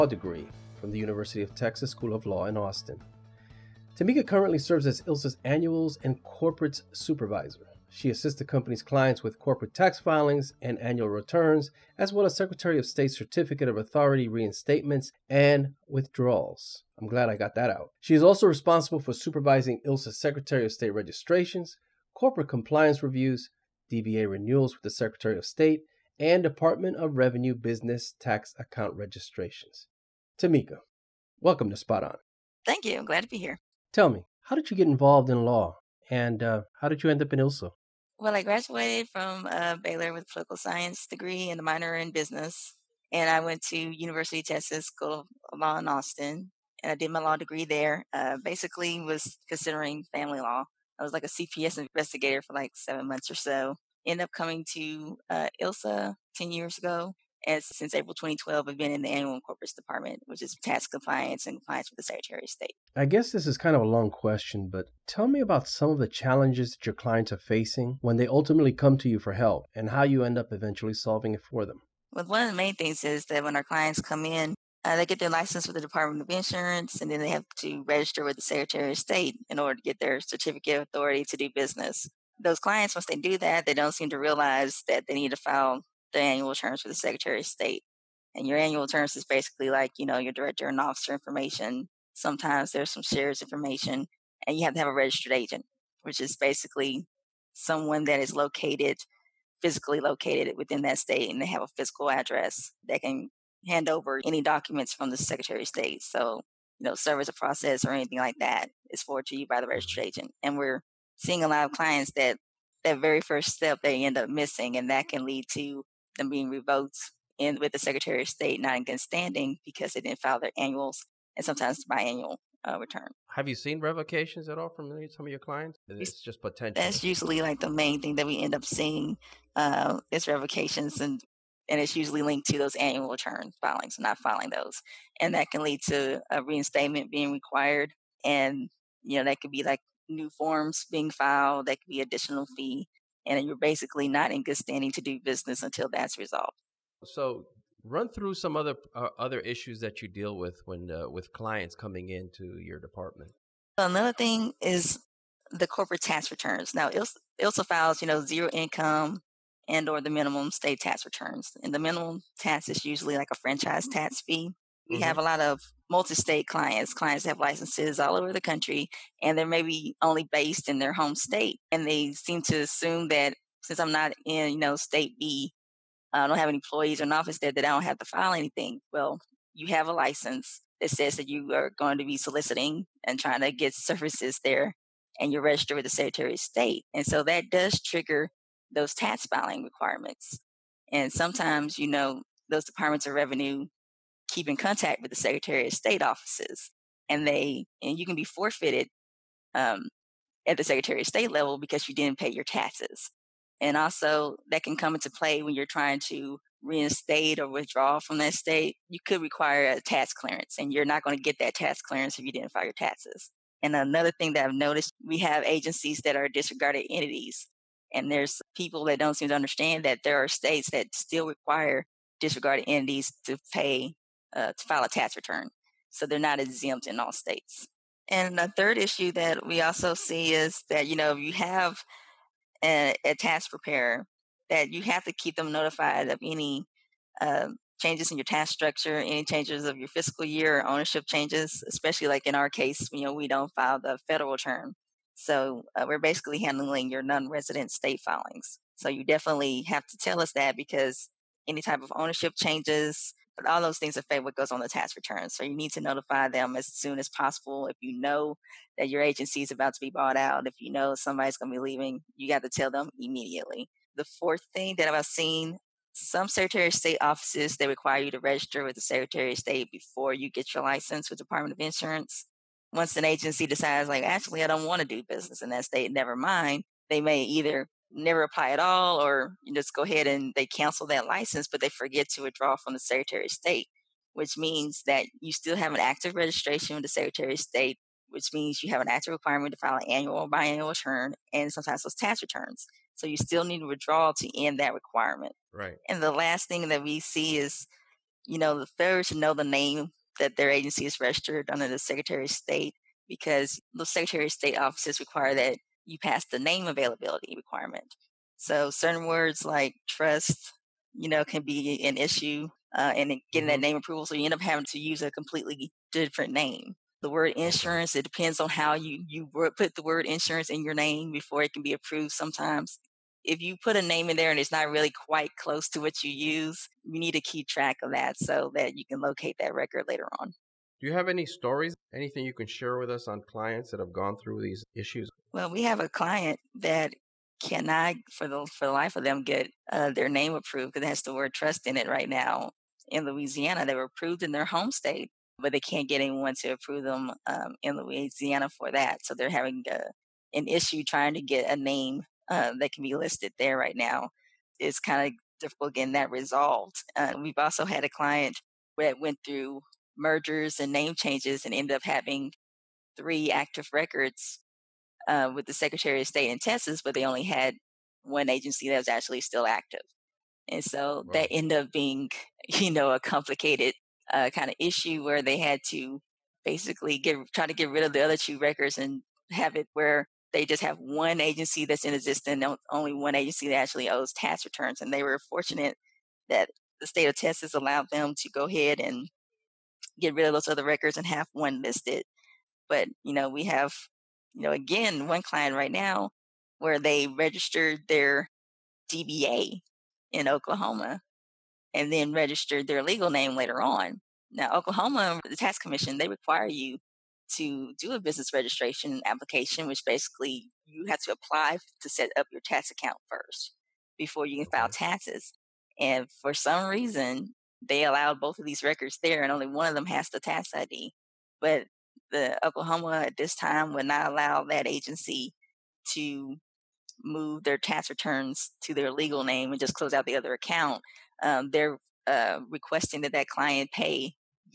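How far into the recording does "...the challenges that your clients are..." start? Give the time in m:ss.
1:05.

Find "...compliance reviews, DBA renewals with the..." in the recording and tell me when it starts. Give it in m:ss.
0:22.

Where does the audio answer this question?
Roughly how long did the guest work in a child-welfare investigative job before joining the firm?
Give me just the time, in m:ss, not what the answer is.
0:52.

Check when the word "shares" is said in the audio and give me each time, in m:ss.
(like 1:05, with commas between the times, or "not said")
1:33, 5:32.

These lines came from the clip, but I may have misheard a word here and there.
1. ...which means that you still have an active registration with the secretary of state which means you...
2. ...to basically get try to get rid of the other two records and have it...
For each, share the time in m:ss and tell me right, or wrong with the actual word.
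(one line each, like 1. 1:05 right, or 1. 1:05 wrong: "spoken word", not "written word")
1. 4:44 right
2. 6:15 right.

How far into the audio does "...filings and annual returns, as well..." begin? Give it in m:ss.
0:10.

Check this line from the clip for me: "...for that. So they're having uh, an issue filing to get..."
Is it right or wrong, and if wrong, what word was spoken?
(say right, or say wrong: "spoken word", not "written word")
wrong: "trying", not "filing".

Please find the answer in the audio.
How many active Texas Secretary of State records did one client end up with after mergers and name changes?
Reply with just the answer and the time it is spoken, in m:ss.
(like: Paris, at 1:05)
3, at 6:02.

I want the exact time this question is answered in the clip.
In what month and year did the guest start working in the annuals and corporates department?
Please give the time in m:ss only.
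0:57.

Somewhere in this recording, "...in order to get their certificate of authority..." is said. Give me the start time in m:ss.
1:19.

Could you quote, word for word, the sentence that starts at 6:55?
And for some reason, they allowed both of these records there, and only one of them has the tax ID.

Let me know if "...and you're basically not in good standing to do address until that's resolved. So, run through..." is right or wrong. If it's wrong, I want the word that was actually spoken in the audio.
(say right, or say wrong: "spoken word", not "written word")
wrong: "business", not "address".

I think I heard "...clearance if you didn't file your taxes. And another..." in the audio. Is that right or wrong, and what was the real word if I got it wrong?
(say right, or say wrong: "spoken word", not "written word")
right.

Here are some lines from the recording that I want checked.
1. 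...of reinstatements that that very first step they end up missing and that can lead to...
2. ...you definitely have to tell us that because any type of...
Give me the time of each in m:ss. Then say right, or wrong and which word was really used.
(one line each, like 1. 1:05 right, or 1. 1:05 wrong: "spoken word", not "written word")
1. 1:51 wrong: "clients", not "reinstatements"
2. 4:08 right.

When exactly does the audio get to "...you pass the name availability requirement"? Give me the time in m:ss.
5:05.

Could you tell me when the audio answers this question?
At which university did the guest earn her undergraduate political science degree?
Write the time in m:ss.
0:39.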